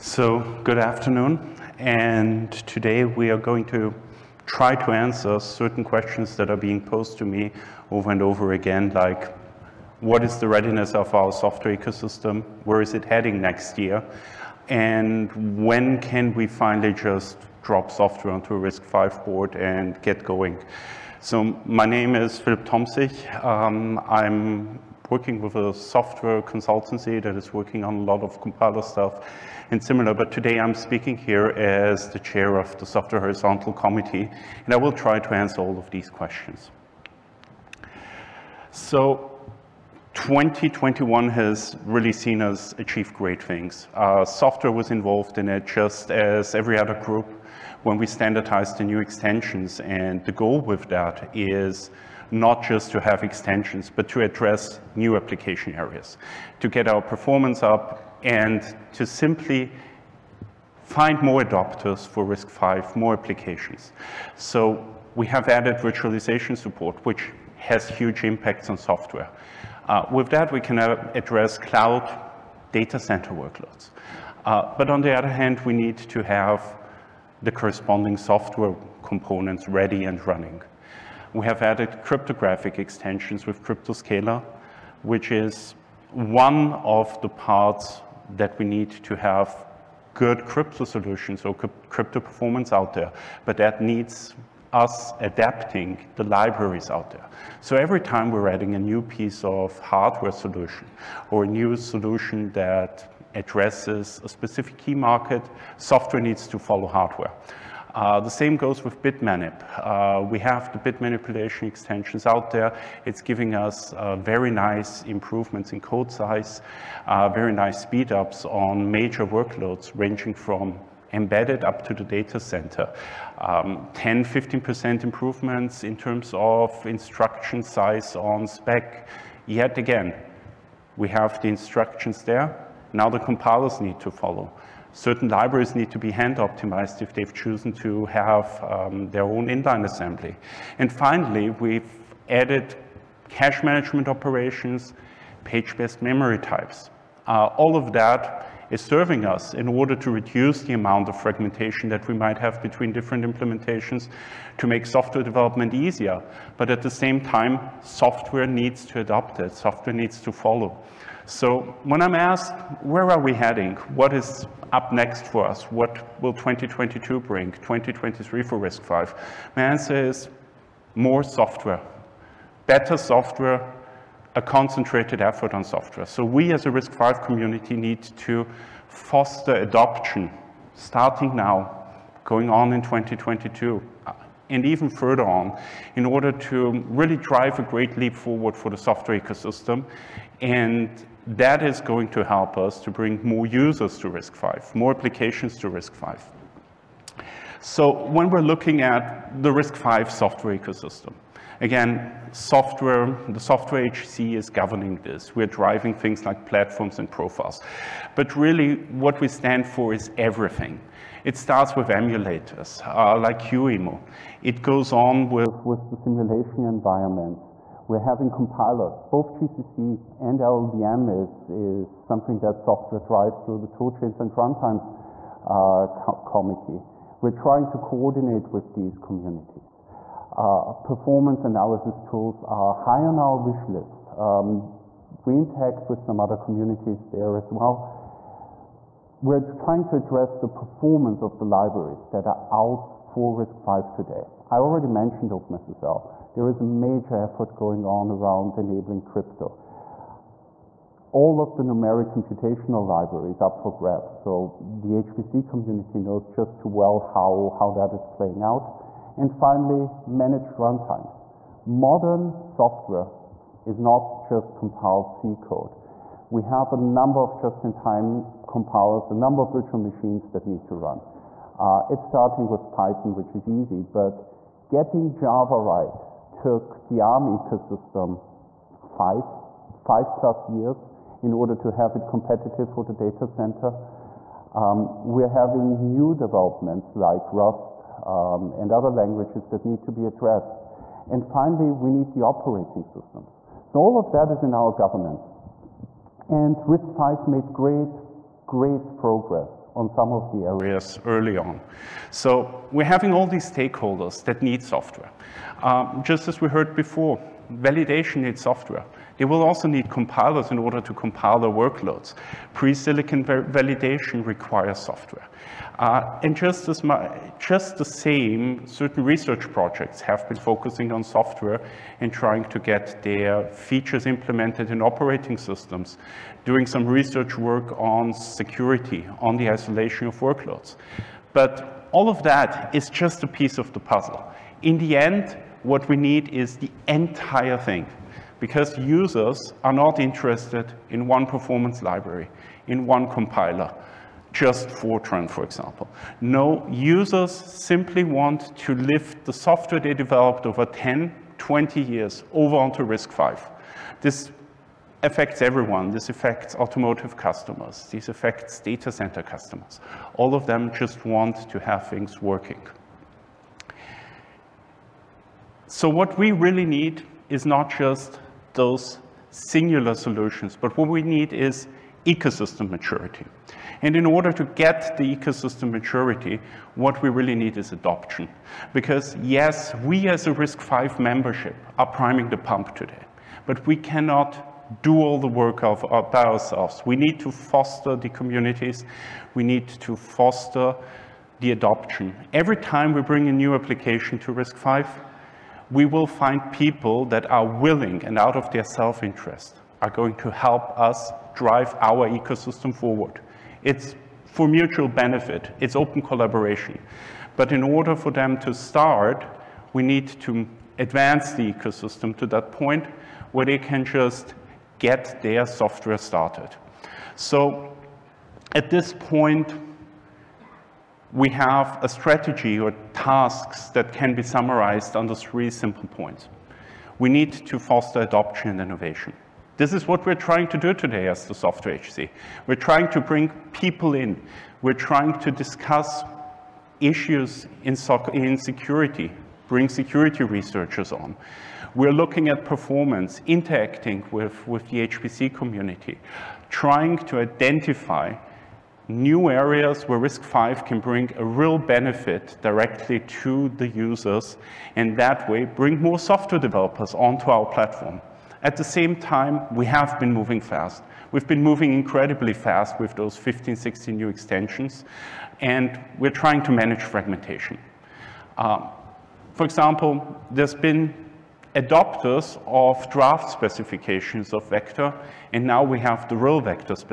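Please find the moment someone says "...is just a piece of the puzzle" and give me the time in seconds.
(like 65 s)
332 s.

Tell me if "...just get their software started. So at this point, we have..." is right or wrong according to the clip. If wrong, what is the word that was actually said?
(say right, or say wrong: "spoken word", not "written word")
right.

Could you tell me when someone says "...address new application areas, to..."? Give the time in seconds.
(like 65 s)
54 s.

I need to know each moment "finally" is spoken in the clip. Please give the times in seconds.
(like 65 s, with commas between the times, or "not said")
16 s, 140 s, 259 s, 291 s.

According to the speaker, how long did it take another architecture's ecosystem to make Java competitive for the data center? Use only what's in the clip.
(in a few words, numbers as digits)
5 plus years.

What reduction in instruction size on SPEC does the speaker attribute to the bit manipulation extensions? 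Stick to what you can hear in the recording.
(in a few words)
10 to 15%.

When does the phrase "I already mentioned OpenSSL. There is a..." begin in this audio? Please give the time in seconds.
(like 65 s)
244 s.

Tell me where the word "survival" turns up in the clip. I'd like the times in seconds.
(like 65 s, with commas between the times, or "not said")
not said.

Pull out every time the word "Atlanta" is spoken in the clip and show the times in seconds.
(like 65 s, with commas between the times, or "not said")
not said.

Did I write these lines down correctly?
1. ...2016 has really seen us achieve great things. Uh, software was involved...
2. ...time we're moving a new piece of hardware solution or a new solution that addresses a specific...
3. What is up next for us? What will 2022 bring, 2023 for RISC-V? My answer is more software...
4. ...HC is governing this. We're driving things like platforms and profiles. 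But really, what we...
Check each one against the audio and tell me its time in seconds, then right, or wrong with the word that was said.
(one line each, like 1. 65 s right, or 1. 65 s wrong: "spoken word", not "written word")
1. 40 s wrong: "2021", not "2016"
2. 98 s wrong: "adding", not "moving"
3. 163 s right
4. 203 s right.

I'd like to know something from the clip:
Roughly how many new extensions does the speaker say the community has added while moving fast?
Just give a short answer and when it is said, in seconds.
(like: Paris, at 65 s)
15 to 16, at 463 s.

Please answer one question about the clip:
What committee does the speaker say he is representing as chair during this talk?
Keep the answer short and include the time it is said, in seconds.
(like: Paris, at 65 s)
Software Horizontal Committee, at 32 s.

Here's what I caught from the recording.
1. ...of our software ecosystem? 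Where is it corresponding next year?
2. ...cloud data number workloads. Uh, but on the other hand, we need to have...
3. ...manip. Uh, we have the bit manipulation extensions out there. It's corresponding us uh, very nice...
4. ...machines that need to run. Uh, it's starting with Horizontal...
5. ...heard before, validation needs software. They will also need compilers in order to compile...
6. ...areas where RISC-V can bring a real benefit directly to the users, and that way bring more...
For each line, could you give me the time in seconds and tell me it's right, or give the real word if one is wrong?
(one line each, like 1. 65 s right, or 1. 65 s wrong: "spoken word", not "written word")
1. 10 s wrong: "heading", not "corresponding"
2. 71 s wrong: "center", not "number"
3. 109 s wrong: "giving", not "corresponding"
4. 269 s wrong: "Python", not "Horizontal"
5. 306 s right
6. 449 s right.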